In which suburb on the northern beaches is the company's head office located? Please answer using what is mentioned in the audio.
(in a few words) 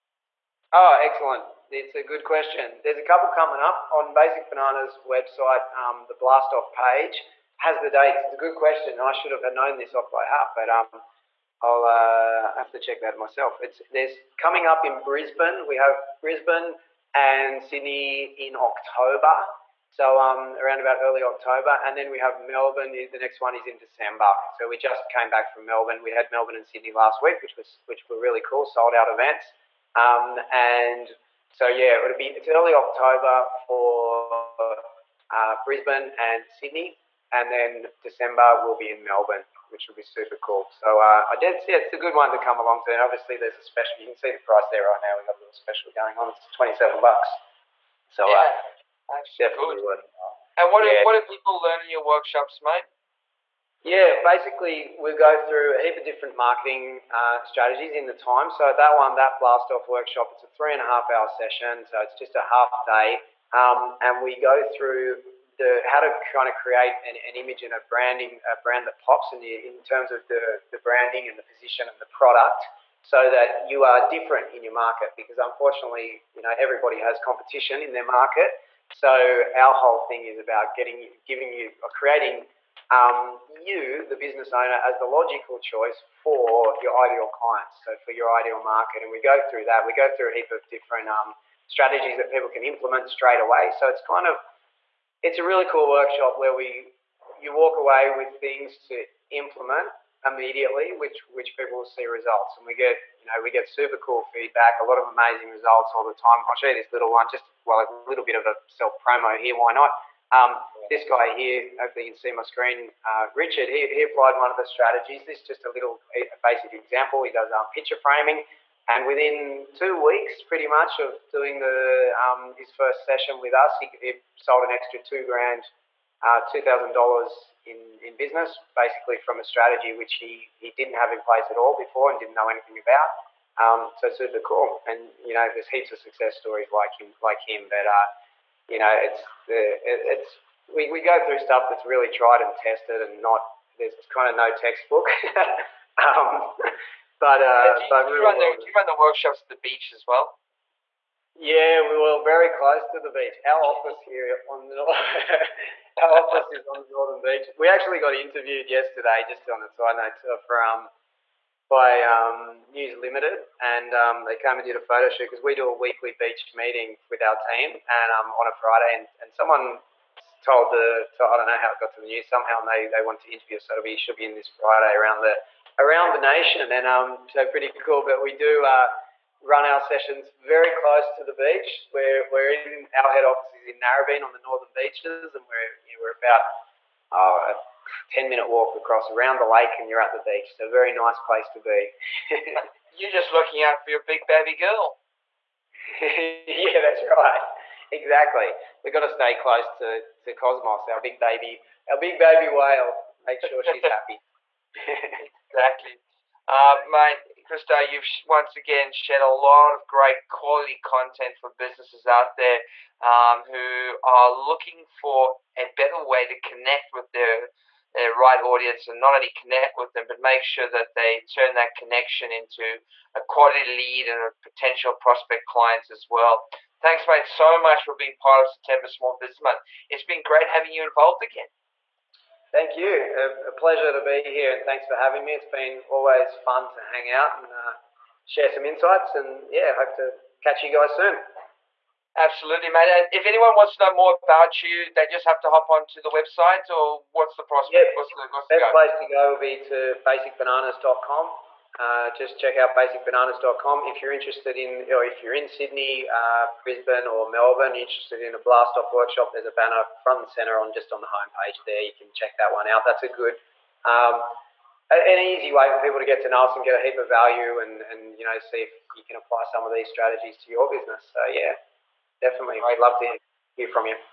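Narrabeen.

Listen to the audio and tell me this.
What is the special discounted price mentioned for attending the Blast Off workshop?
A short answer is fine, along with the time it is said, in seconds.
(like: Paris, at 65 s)
$27, at 46 s.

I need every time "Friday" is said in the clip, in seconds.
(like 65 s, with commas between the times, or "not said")
168 s, 174 s.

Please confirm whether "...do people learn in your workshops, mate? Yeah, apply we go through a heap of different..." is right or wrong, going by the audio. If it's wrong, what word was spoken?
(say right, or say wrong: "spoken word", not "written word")
wrong: "basically", not "apply".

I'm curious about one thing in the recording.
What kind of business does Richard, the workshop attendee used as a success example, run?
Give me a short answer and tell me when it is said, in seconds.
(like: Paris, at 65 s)
picture framing, at 117 s.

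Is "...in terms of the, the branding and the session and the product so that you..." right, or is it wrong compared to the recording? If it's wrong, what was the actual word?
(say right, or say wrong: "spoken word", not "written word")
wrong: "position", not "session".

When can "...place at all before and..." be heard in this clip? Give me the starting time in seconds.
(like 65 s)
131 s.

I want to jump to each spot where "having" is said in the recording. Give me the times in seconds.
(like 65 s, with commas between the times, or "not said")
230 s, 234 s.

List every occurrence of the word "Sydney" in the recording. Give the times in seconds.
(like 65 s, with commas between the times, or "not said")
17 s, 26 s, 36 s, 255 s.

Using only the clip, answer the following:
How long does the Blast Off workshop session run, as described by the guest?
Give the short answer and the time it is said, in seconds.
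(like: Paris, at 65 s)
3.5 hours, at 60 s.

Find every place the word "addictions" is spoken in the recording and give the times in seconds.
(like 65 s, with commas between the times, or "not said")
not said.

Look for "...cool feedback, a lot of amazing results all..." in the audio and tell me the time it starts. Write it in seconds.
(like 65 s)
103 s.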